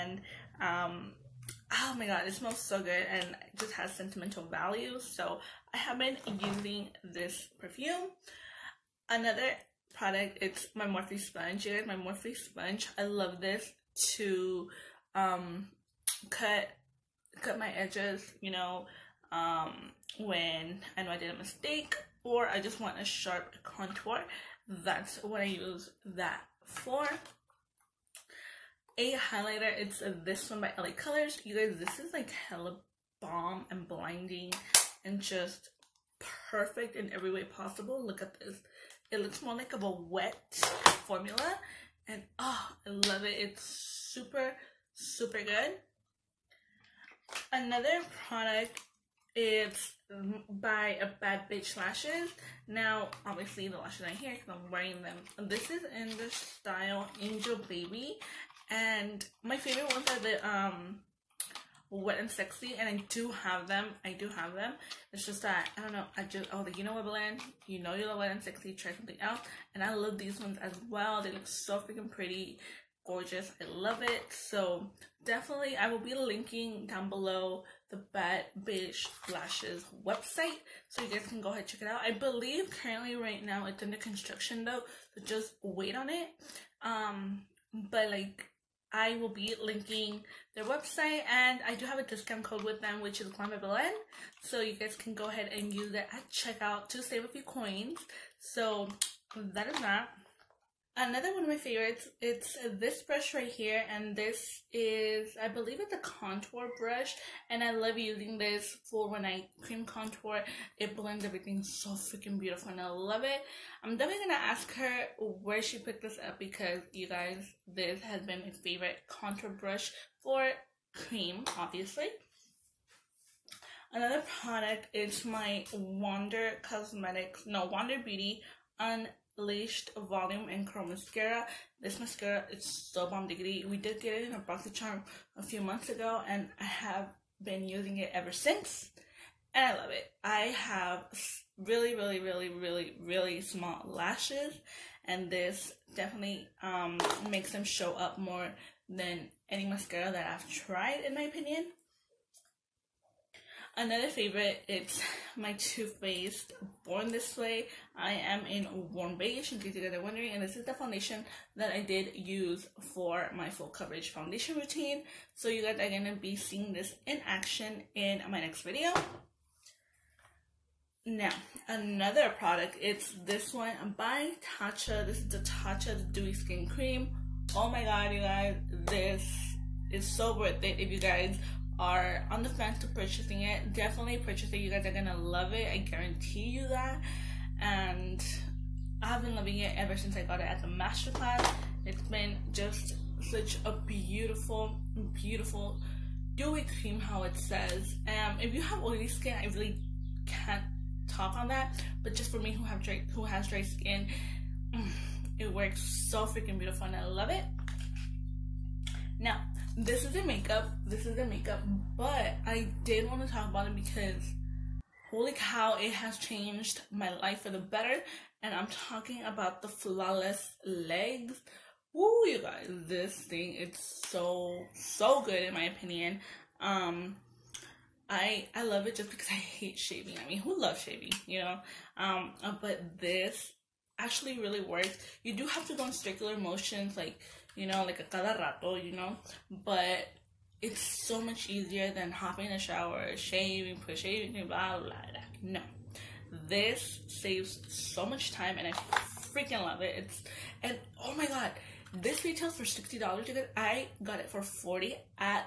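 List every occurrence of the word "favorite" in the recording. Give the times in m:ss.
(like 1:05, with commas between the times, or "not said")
0:59, 1:41, 1:58, 2:34.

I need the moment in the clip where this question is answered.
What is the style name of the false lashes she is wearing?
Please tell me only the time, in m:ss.
0:57.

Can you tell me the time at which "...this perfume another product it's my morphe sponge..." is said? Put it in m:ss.
0:07.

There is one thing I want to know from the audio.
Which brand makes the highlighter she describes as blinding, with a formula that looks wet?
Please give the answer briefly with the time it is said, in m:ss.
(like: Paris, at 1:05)
LA Colors, at 0:30.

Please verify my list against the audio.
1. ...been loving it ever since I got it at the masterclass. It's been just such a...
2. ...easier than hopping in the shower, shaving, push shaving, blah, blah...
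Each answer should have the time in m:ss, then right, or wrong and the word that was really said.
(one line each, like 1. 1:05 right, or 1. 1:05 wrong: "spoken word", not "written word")
1. 3:09 right
2. 4:01 right.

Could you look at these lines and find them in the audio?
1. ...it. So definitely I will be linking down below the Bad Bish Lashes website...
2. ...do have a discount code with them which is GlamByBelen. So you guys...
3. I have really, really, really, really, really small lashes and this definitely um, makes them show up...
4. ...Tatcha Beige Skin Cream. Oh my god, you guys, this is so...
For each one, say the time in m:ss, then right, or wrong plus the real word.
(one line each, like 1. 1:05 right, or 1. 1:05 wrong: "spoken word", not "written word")
1. 1:14 right
2. 1:31 right
3. 2:20 right
4. 2:55 wrong: "Dewy", not "Beige".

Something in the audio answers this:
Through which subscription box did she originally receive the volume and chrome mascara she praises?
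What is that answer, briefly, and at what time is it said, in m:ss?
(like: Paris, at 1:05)
BoxyCharm, at 2:14.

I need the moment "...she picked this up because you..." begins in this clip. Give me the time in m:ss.
1:55.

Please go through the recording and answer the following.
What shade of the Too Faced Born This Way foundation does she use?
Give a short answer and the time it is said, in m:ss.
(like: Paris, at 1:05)
Warm Beige, at 2:38.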